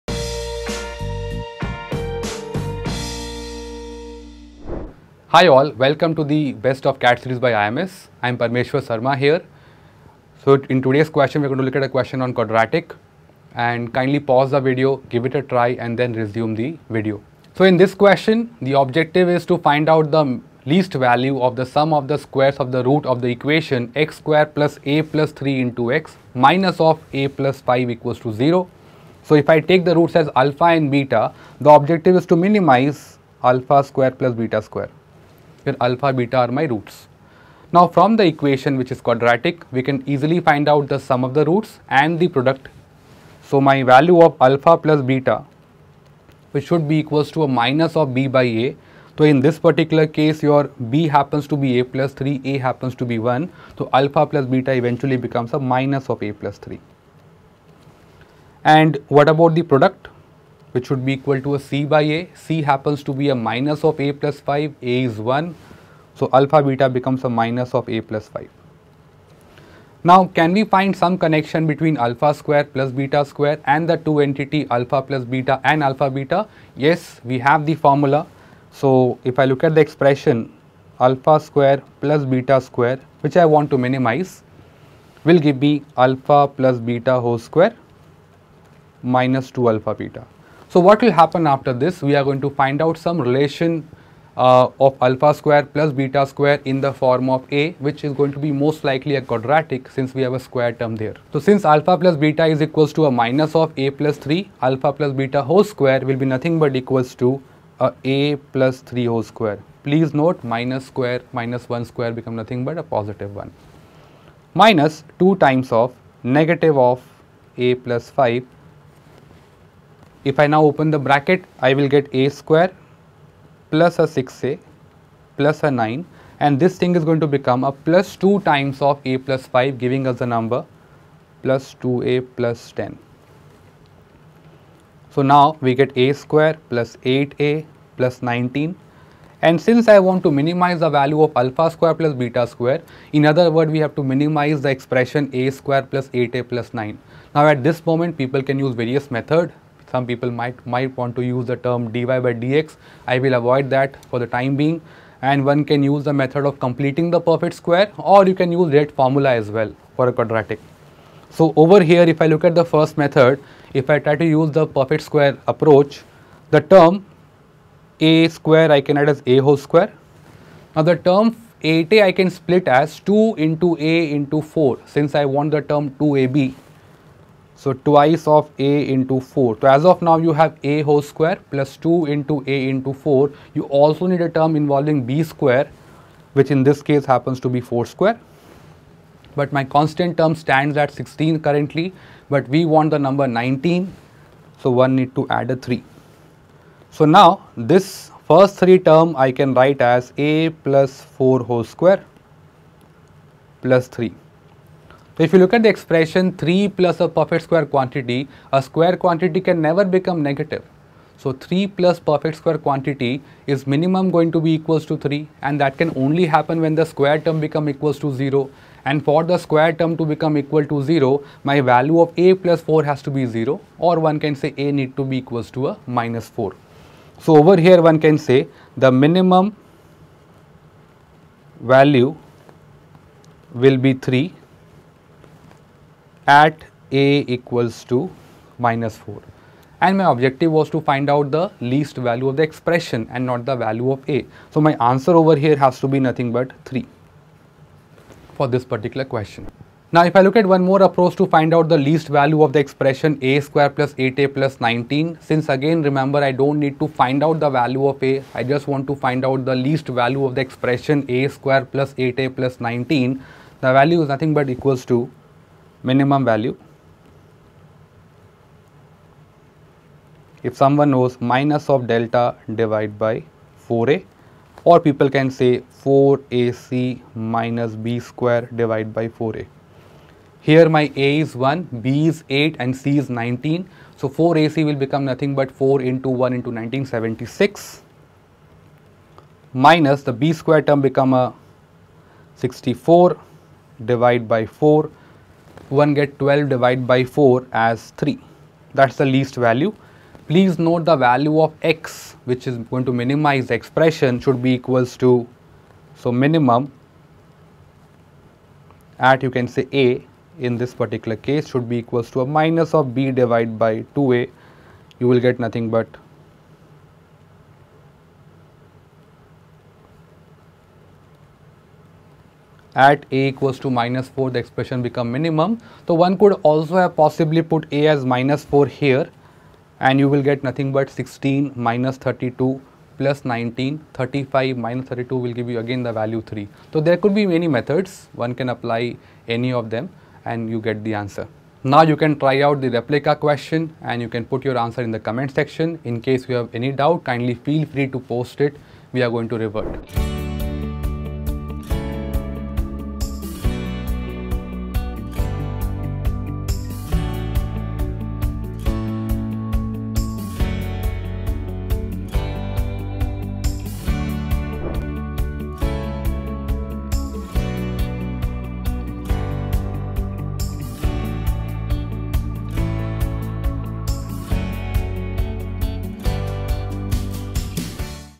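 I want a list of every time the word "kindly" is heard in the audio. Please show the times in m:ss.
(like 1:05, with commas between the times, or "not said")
0:13, 5:47.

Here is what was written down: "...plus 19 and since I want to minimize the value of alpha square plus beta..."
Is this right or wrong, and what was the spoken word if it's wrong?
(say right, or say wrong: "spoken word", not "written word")
right.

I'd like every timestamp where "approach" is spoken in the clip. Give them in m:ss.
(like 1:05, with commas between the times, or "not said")
2:45, 4:10.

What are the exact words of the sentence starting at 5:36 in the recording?
So there could be many methods one can apply any of them and you get the answer.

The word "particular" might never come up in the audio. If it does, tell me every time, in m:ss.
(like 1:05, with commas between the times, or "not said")
0:49, 4:08, 5:10.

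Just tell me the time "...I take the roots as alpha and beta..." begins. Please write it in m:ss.
0:29.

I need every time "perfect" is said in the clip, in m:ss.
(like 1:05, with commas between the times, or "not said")
2:37, 2:44, 3:27, 3:31.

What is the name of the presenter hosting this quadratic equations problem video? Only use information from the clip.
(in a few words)
Parmeshwar Sharma.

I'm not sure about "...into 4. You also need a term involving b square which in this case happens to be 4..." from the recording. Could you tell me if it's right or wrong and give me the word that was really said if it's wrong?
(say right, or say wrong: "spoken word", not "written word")
right.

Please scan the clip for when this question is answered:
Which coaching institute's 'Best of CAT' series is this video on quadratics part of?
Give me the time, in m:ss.
0:07.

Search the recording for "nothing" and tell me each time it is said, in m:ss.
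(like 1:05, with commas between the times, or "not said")
1:46, 1:52, 4:06, 4:24, 4:45, 5:15, 5:30.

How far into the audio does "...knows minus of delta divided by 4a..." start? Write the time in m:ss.
4:30.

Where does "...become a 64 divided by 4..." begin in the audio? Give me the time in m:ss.
4:50.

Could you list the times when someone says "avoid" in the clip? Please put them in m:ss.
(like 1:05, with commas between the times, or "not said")
2:33.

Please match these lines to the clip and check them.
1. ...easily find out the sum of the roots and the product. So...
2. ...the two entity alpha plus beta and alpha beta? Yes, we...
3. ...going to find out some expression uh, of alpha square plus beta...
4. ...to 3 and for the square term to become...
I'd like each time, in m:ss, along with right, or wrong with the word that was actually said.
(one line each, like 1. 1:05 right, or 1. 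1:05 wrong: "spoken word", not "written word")
1. 0:40 right
2. 1:13 right
3. 1:32 wrong: "relation", not "expression"
4. 3:37 wrong: "0", not "3".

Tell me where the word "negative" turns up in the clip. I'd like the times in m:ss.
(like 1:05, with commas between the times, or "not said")
1:56, 3:30.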